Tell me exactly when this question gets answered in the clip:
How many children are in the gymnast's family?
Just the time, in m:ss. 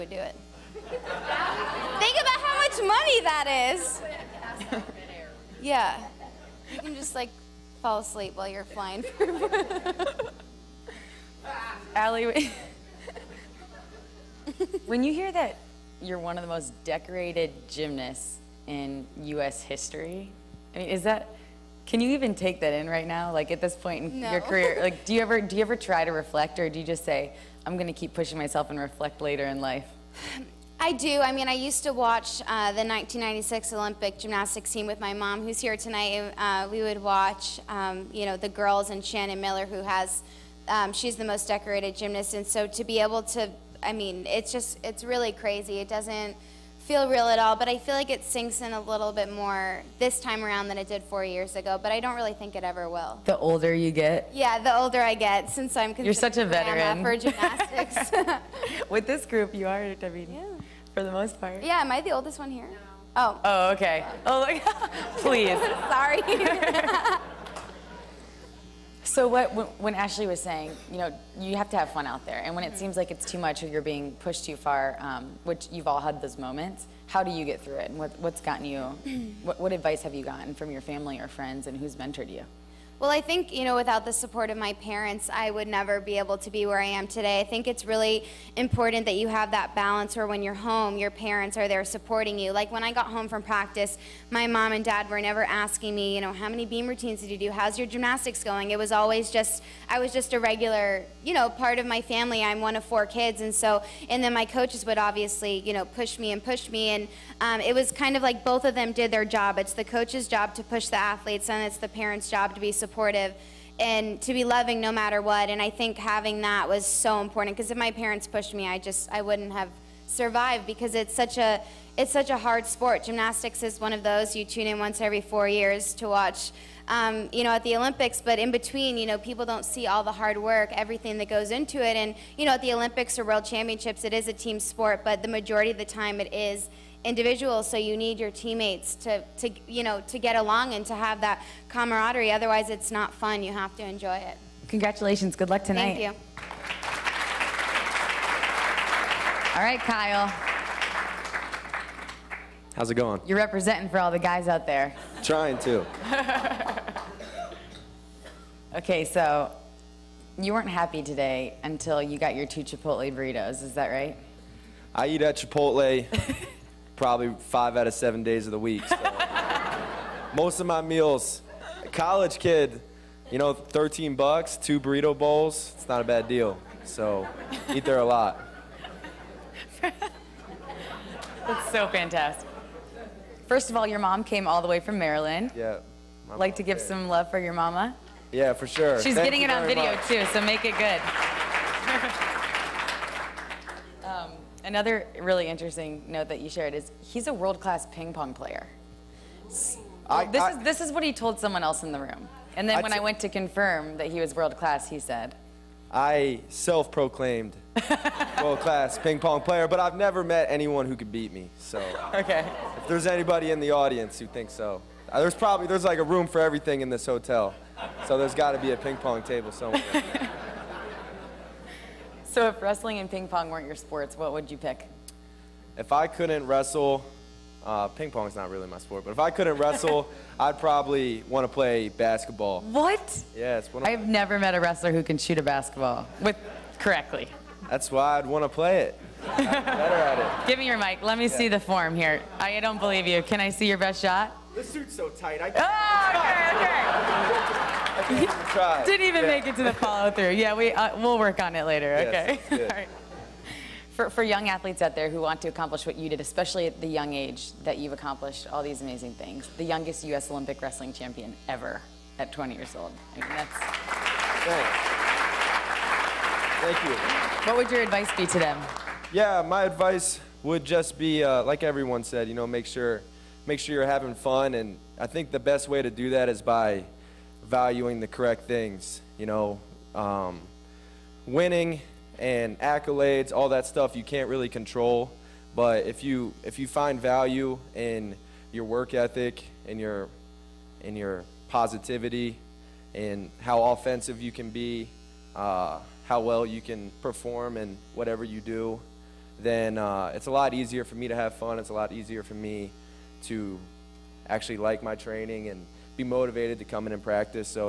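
1:42.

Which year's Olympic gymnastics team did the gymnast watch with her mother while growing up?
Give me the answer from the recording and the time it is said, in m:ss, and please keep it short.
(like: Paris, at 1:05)
1996, at 0:32.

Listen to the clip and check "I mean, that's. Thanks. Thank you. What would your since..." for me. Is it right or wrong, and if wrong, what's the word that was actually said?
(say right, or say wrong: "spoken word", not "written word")
wrong: "advice", not "since".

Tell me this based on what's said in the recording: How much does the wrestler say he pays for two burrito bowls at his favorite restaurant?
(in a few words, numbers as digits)
13 bucks.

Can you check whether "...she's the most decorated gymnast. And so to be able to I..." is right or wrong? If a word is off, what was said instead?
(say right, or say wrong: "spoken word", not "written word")
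right.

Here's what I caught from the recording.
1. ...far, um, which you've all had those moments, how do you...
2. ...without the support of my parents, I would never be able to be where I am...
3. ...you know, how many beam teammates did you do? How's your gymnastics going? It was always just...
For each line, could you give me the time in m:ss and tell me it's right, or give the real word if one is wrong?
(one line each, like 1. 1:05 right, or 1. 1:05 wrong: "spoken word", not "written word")
1. 1:14 right
2. 1:23 right
3. 1:36 wrong: "routines", not "teammates".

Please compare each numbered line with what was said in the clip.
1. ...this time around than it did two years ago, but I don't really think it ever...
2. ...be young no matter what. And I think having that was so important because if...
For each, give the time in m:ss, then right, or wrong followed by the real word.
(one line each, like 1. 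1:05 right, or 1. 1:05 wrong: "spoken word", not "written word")
1. 0:49 wrong: "four", not "two"
2. 1:54 wrong: "loving", not "young".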